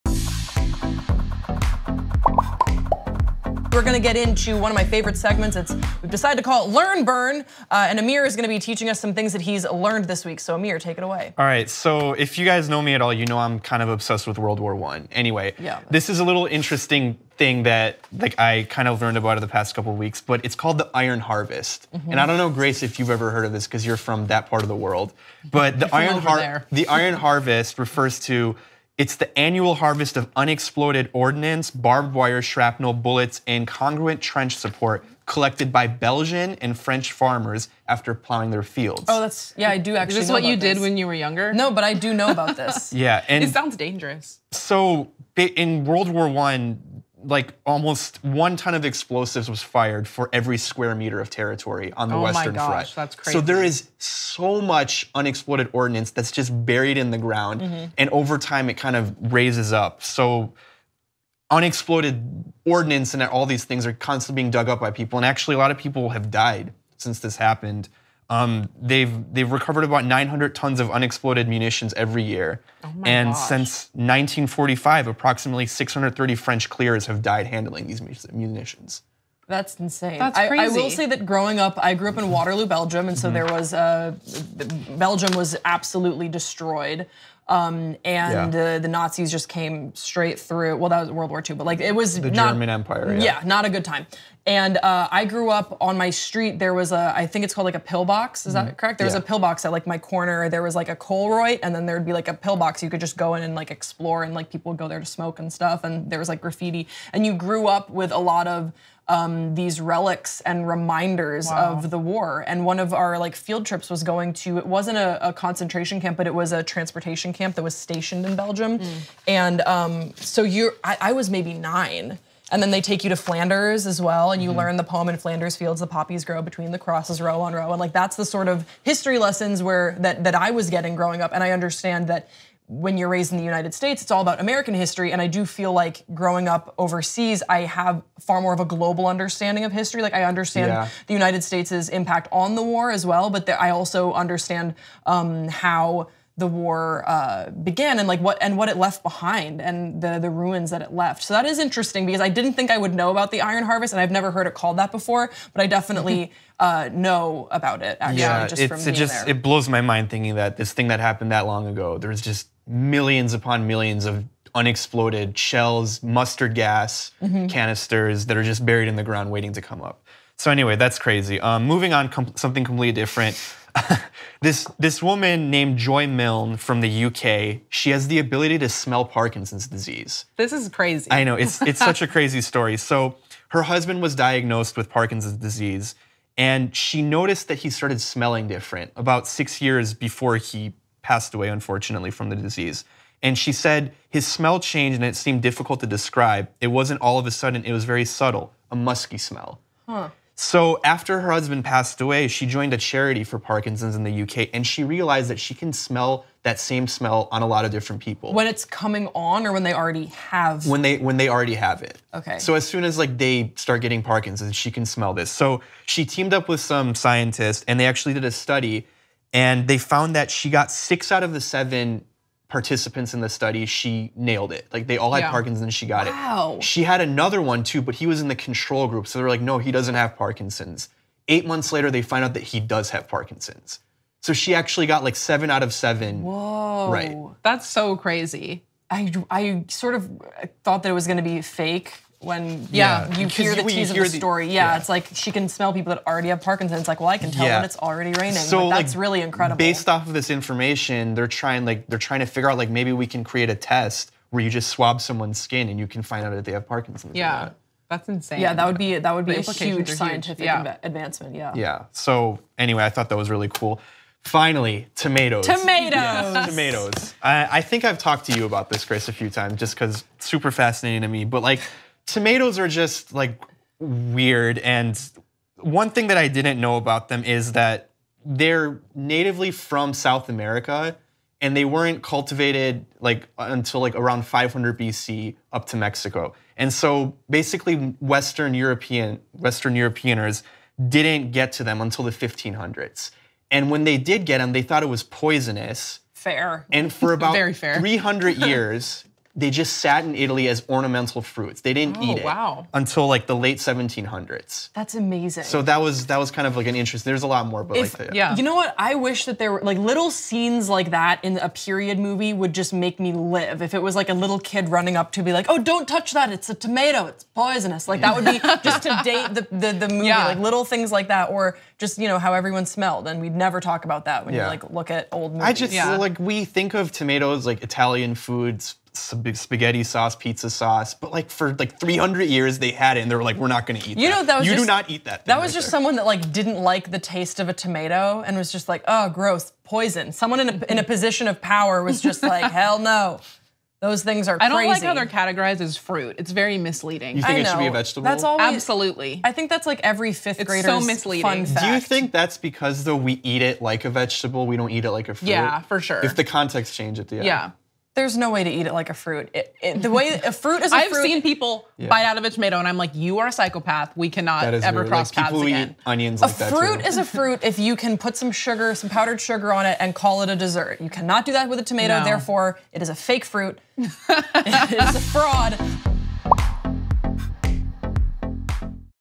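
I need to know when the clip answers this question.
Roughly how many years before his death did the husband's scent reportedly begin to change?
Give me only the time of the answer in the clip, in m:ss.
3:09.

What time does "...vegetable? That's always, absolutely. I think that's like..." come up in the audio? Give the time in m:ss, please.
5:47.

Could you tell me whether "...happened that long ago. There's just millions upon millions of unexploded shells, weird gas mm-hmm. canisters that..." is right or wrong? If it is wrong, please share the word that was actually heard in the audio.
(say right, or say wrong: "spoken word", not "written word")
wrong: "mustard", not "weird".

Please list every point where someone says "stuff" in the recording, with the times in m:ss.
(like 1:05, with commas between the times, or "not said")
1:45.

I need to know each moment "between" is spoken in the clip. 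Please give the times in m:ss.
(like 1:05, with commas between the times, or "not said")
2:06.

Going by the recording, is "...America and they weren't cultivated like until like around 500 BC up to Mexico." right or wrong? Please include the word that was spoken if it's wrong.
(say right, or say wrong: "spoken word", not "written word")
right.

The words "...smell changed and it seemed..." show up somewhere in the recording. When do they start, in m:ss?
3:14.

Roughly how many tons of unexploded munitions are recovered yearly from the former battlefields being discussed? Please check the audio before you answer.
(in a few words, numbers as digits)
900 tons.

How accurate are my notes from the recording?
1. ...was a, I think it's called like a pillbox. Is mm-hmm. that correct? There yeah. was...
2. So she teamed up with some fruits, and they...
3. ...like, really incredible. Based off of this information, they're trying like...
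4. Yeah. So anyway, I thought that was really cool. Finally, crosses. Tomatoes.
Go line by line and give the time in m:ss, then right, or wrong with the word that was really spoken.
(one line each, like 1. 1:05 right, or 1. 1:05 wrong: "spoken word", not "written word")
1. 1:36 right
2. 3:35 wrong: "scientists", not "fruits"
3. 4:08 right
4. 4:21 wrong: "tomatoes", not "crosses".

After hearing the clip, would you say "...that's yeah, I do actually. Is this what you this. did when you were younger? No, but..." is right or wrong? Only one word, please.
right.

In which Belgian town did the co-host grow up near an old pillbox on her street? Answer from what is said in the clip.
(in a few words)
Waterloo.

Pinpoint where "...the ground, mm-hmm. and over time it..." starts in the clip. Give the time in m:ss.
0:57.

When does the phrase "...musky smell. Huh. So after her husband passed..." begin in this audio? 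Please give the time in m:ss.
3:18.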